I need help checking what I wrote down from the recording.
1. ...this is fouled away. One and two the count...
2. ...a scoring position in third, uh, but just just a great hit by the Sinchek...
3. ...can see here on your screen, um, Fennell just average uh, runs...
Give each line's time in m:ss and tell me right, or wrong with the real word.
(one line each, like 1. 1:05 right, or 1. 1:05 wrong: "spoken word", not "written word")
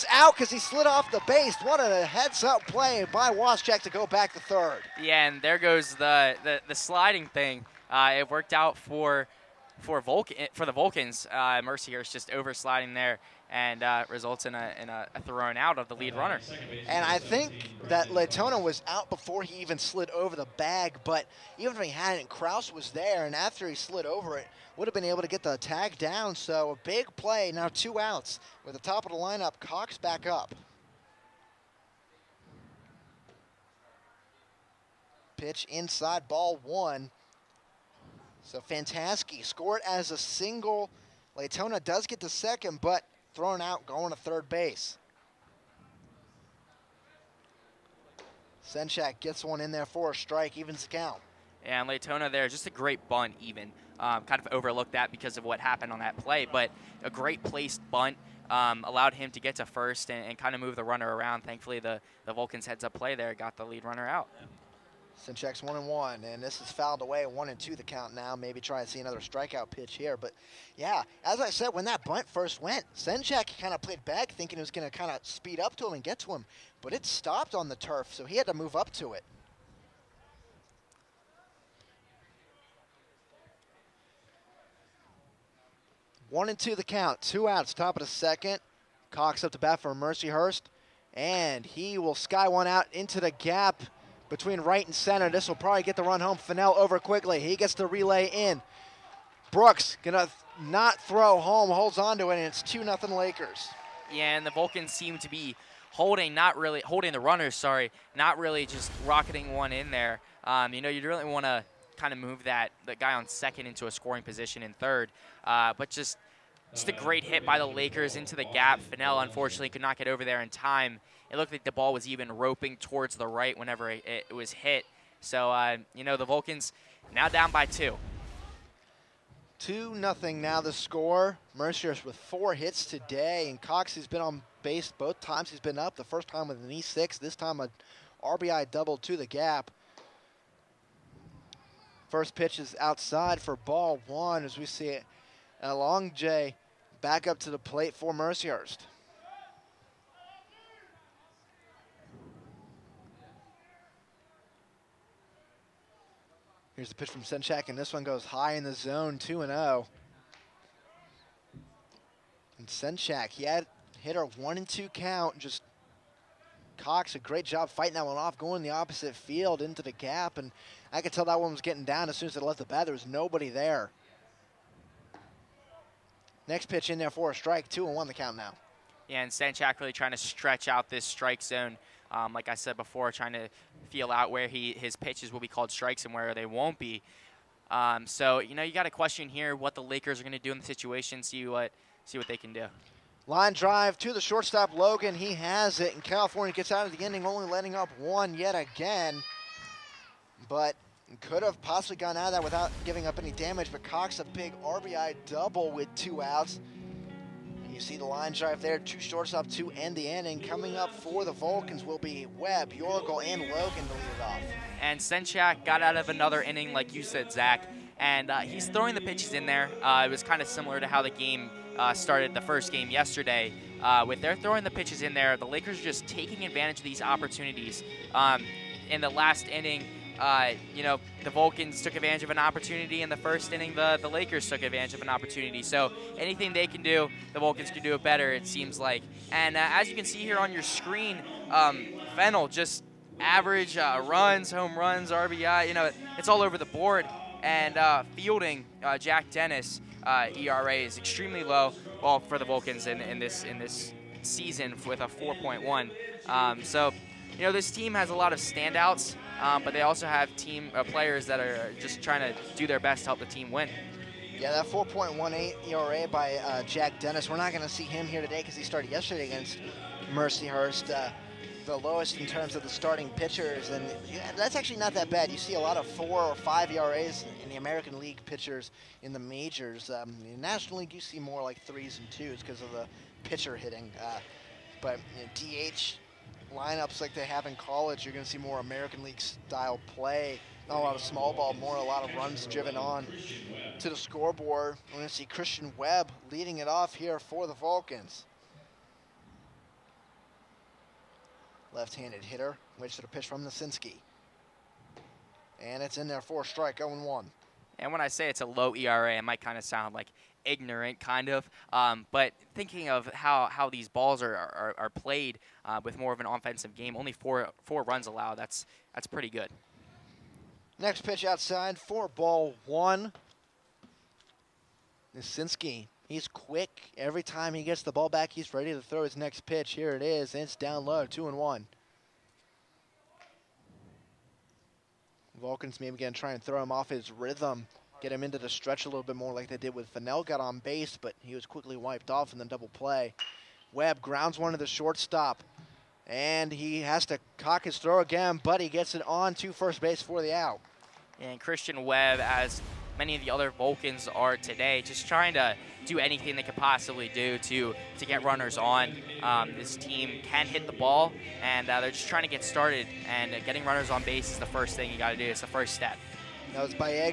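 1. 1:06 right
2. 1:53 wrong: "Lakers", not "Sinchek"
3. 3:59 right.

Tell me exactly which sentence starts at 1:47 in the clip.
Sorry, not really just rocketing one in there.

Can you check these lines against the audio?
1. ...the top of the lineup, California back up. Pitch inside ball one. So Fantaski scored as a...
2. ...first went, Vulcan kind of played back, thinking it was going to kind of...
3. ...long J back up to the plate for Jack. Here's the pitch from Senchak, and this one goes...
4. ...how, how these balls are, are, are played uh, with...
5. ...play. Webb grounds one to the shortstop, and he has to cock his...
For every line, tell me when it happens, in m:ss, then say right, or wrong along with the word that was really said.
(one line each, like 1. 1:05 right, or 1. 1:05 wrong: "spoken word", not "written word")
1. 0:28 wrong: "Cox", not "California"
2. 1:12 wrong: "Sinchek", not "Vulcan"
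3. 2:25 wrong: "Mercyhurst", not "Jack"
4. 5:13 right
5. 5:42 right.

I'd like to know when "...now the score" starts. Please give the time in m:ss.
2:10.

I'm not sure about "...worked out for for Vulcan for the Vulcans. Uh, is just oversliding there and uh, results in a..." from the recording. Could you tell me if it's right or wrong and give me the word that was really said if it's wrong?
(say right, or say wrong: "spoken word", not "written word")
right.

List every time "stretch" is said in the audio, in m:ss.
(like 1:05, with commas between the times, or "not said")
3:00, 5:38.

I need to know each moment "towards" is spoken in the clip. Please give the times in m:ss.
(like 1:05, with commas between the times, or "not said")
2:02.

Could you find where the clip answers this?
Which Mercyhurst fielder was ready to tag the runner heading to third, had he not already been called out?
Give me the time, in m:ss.
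0:22.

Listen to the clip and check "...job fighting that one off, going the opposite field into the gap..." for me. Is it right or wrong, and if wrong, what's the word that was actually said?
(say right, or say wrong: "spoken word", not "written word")
right.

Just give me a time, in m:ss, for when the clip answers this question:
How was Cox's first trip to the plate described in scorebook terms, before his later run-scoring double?
2:16.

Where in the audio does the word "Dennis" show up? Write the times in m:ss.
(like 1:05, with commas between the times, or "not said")
4:09, 4:26.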